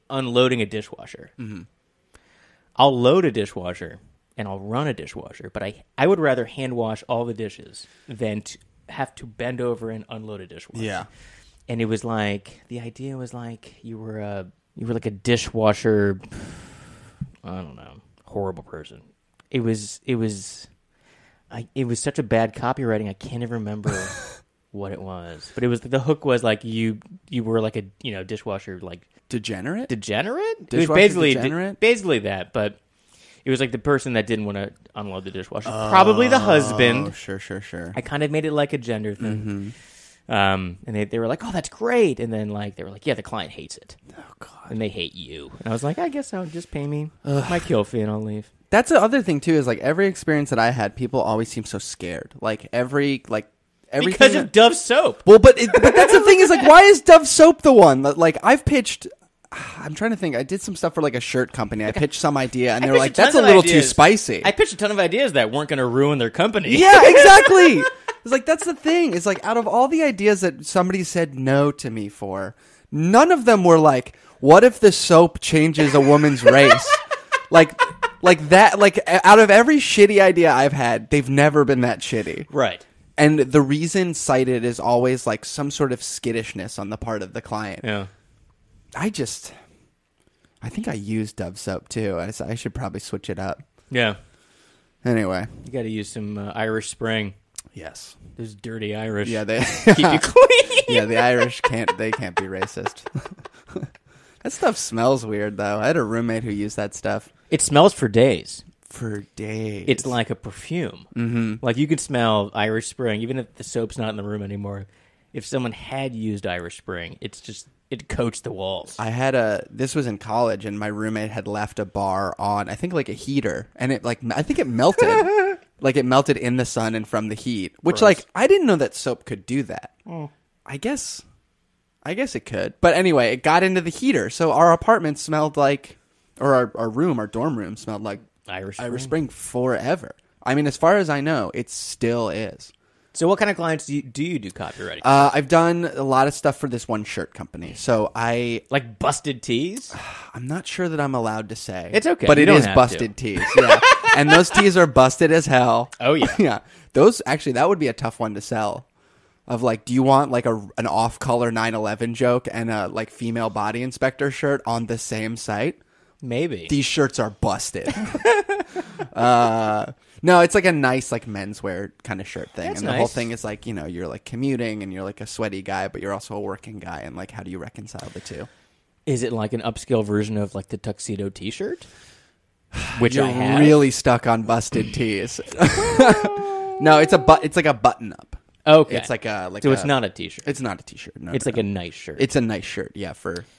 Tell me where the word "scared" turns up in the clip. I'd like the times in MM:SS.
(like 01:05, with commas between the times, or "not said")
00:51.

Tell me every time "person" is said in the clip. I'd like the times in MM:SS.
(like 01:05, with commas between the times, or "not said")
00:18, 00:33.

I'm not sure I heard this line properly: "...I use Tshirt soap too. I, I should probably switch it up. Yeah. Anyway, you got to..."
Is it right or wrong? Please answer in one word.
wrong.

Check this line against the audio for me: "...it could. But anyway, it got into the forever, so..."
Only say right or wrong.
wrong.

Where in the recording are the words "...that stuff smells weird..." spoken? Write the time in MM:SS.
01:44.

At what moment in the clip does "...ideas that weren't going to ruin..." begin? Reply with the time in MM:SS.
01:04.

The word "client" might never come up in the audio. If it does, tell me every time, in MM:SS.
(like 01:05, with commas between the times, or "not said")
00:43, 01:27, 02:23.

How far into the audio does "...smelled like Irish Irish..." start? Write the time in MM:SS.
02:17.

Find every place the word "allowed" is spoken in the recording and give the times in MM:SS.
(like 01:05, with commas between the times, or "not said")
02:31.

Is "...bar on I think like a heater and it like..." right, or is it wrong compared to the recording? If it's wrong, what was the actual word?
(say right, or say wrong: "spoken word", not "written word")
right.